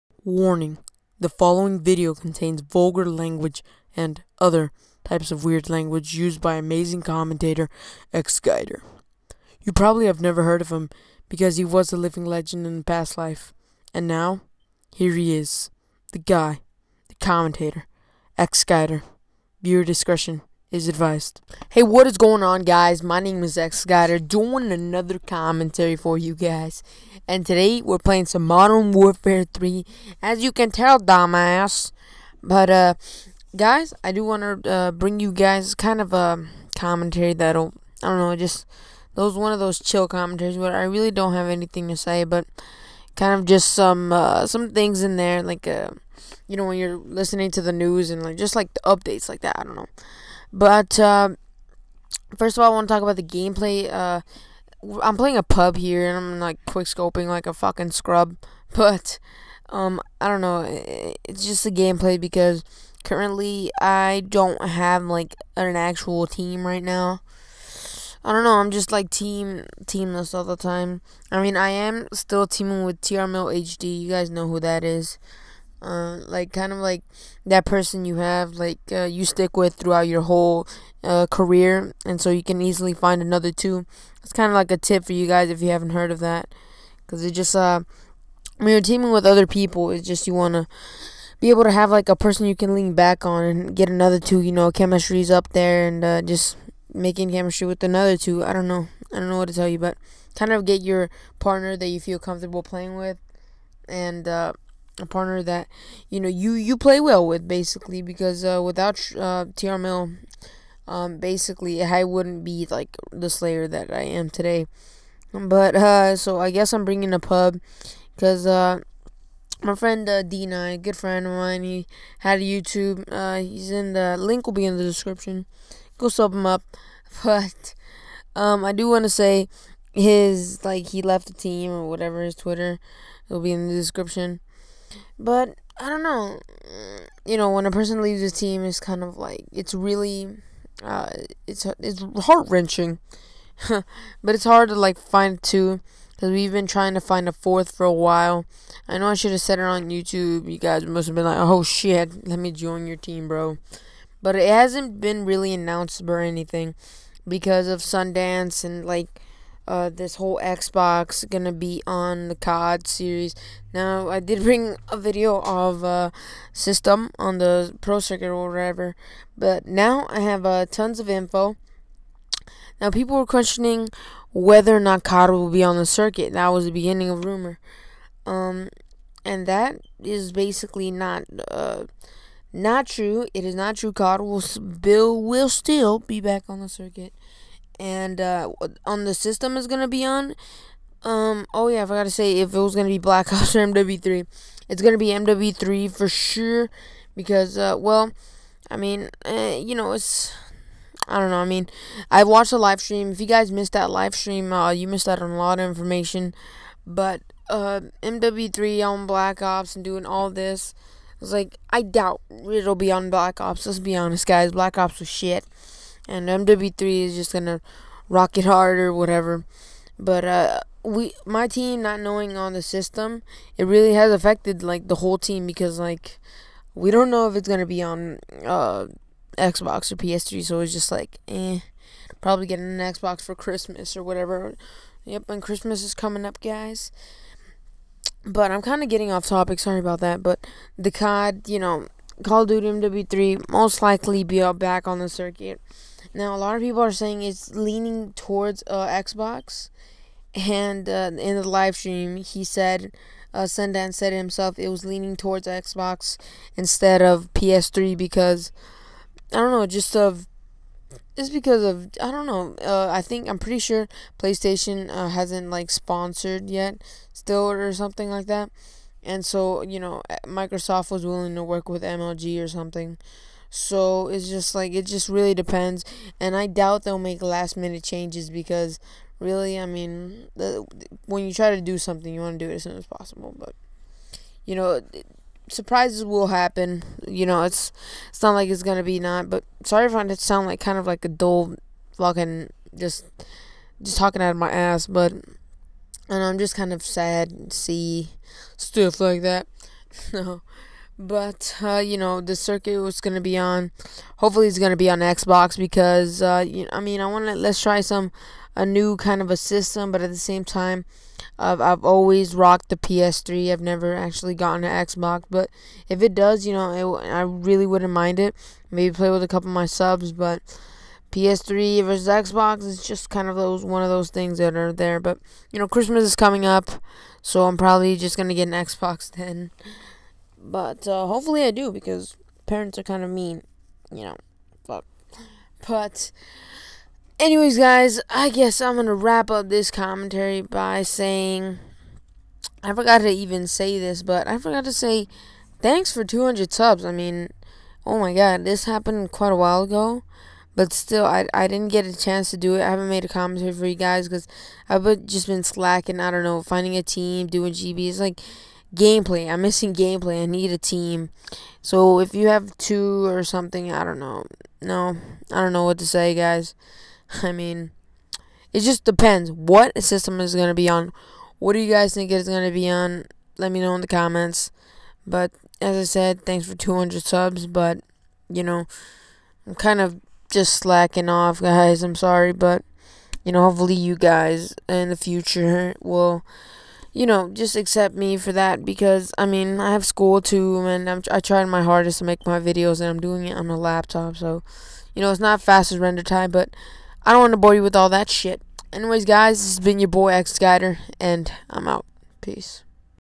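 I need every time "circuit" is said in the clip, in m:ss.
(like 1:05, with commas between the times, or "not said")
2:48, 2:55, 3:06, 4:05, 5:02.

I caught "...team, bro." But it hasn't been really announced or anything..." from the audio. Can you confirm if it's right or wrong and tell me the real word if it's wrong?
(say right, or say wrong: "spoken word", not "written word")
right.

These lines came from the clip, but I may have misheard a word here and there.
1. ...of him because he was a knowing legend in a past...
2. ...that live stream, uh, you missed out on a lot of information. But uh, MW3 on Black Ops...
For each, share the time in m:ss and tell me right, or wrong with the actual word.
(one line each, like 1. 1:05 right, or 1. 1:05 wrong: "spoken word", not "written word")
1. 0:10 wrong: "living", not "knowing"
2. 3:23 right.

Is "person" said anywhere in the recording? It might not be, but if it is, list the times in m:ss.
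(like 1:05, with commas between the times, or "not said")
1:17, 1:32, 2:17.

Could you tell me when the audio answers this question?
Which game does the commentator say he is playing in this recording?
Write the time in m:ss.
0:28.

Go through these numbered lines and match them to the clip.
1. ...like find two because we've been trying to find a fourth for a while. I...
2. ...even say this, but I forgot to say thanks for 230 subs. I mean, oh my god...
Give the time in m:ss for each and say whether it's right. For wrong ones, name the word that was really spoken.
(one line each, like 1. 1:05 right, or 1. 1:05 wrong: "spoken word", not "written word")
1. 2:24 right
2. 5:43 wrong: "200", not "230".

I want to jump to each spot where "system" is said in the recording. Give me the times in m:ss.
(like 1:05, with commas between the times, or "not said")
2:46, 3:09, 3:42, 5:09, 6:09.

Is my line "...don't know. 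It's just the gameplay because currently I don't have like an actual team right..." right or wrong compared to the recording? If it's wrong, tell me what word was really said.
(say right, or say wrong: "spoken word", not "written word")
right.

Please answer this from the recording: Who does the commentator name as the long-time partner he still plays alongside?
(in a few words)
TR HD.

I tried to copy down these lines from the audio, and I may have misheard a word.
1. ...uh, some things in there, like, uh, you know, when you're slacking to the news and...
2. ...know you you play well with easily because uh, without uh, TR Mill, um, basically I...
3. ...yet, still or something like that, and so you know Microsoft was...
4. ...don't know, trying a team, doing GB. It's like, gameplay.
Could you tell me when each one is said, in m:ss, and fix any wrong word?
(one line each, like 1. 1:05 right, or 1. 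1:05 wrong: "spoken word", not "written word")
1. 0:44 wrong: "listening", not "slacking"
2. 1:46 wrong: "basically", not "easily"
3. 4:26 right
4. 5:56 wrong: "finding", not "trying".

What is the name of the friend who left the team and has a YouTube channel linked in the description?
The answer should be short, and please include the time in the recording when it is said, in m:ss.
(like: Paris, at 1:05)
Dina, at 2:00.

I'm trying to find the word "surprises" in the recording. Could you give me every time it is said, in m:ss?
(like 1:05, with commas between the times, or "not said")
4:45.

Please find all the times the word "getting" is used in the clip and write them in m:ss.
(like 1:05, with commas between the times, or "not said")
3:52, 3:58.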